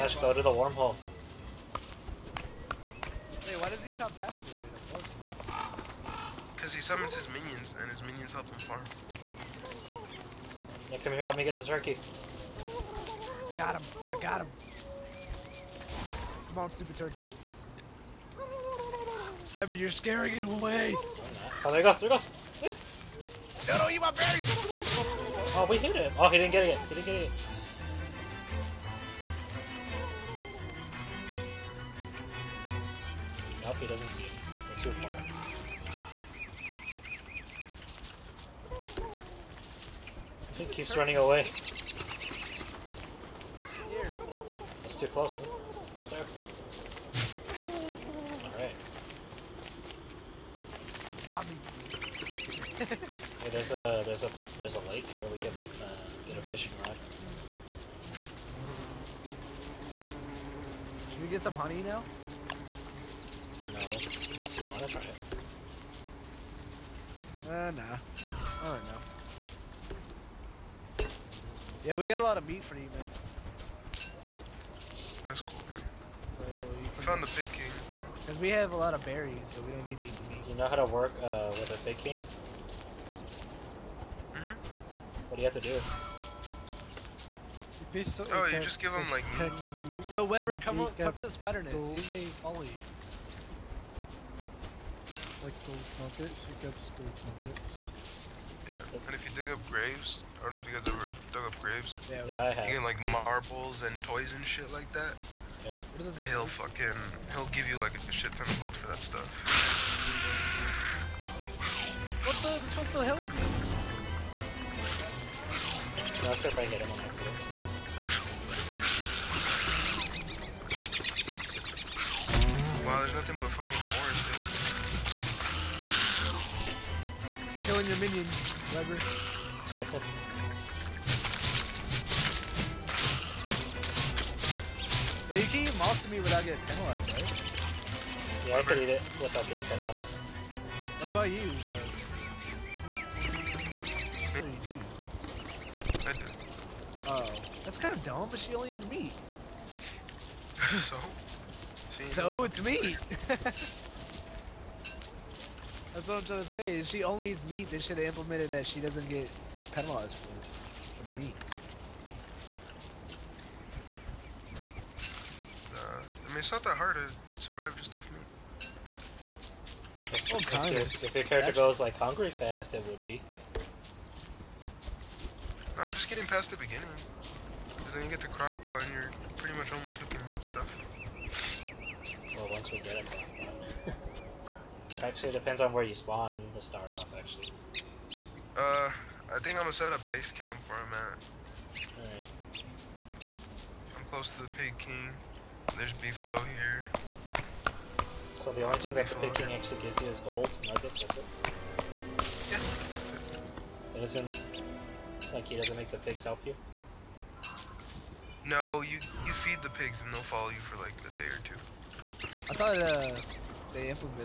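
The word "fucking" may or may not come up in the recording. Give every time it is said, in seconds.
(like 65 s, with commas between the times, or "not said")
106 s, 123 s.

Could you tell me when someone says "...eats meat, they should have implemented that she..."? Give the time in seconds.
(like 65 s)
157 s.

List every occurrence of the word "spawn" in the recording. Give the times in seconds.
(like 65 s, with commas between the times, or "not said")
185 s.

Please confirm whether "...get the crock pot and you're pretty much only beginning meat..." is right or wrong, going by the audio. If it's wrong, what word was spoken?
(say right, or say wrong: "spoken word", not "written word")
wrong: "cooking", not "beginning".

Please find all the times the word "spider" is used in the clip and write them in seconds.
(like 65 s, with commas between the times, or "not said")
91 s.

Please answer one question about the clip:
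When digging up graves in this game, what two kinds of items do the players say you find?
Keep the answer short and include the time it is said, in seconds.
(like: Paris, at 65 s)
Marbles and toys, at 103 s.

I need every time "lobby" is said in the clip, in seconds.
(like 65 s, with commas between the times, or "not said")
51 s.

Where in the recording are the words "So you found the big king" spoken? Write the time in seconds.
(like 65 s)
76 s.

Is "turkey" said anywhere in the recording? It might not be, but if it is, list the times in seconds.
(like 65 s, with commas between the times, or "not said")
11 s, 16 s.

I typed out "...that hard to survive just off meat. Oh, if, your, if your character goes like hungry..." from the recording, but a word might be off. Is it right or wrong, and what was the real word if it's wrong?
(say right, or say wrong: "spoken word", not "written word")
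right.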